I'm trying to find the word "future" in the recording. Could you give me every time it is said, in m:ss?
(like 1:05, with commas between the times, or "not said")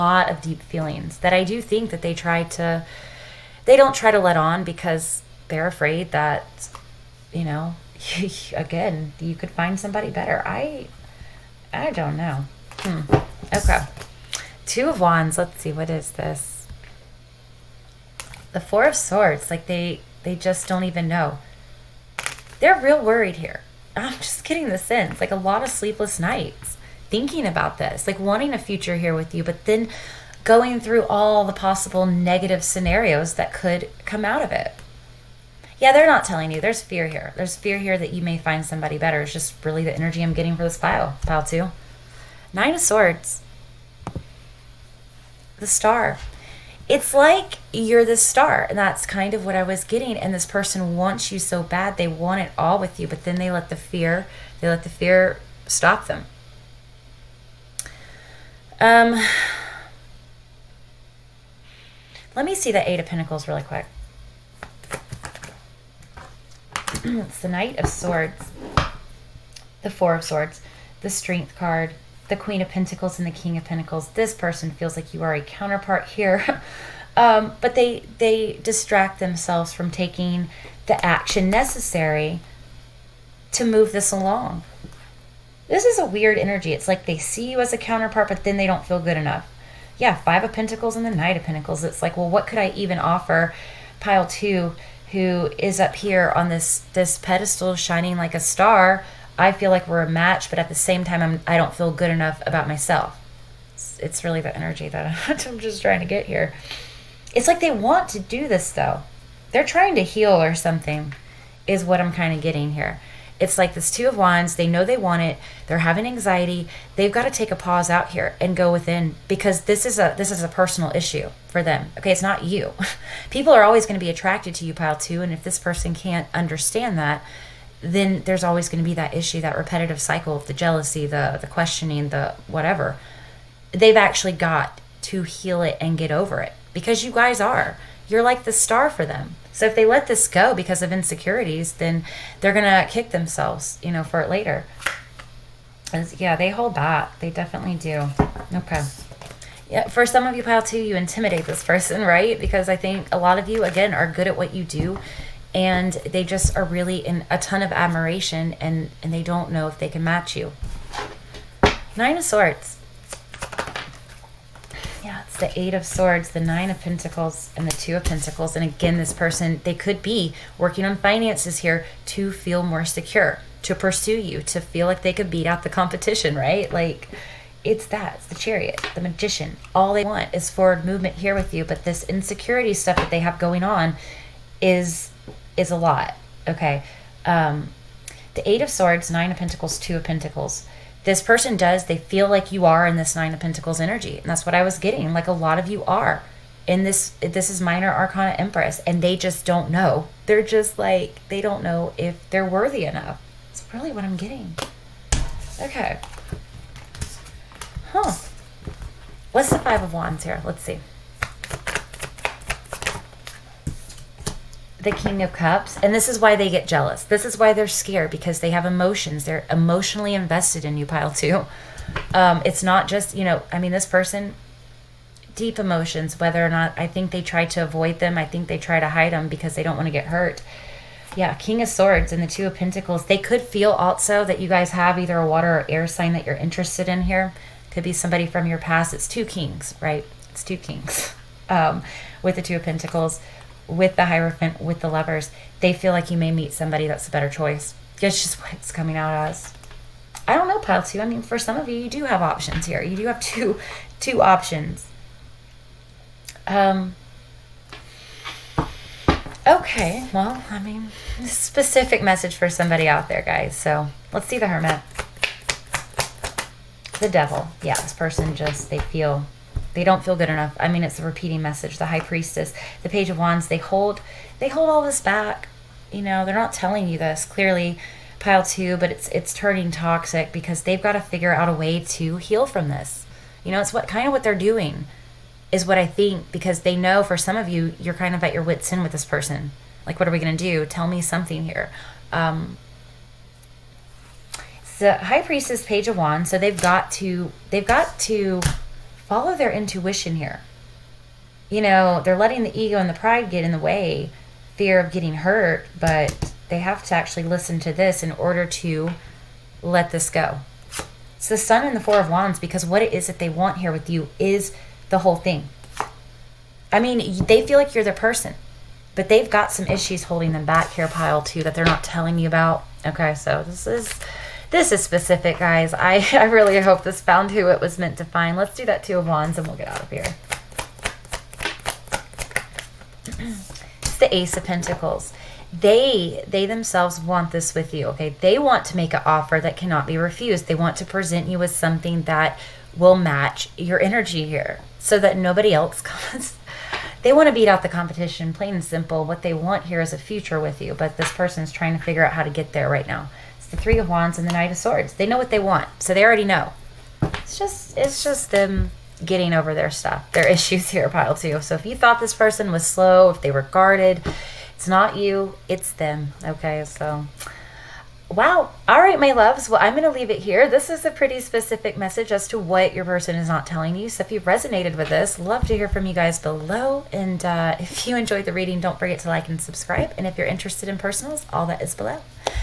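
0:28, 5:49.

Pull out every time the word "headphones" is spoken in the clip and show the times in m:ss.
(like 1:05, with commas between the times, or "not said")
not said.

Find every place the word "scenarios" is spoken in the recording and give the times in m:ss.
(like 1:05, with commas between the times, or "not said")
0:32.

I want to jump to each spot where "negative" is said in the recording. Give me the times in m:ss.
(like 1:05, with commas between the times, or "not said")
0:32.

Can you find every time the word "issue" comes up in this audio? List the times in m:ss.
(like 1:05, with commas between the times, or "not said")
2:00, 2:09, 5:19, 6:00.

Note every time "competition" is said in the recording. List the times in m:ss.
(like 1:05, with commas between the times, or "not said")
2:55, 5:47.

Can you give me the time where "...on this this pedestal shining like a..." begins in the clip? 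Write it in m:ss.
1:36.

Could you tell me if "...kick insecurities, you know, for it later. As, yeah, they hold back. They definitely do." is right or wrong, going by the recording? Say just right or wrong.
wrong.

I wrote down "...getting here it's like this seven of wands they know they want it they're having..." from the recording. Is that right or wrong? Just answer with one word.
wrong.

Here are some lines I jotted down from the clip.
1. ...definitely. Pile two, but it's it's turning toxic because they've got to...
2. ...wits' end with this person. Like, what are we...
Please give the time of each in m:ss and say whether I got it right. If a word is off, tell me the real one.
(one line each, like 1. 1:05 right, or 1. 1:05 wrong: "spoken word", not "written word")
1. 4:37 wrong: "clearly", not "definitely"
2. 4:48 right.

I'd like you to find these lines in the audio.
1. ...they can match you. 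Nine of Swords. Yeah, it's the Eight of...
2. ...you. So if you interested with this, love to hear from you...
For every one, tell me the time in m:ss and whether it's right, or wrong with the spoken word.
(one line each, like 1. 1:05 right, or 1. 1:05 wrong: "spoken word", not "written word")
1. 2:39 right
2. 6:13 wrong: "resonated", not "interested".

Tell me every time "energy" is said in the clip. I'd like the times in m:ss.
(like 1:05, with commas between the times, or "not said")
0:39, 1:26, 1:44, 3:13, 5:43.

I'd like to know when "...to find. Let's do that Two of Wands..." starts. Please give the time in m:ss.
5:27.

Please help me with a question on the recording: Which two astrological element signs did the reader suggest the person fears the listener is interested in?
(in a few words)
Water or air.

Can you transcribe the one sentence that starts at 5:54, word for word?
They know what they want, so they already know.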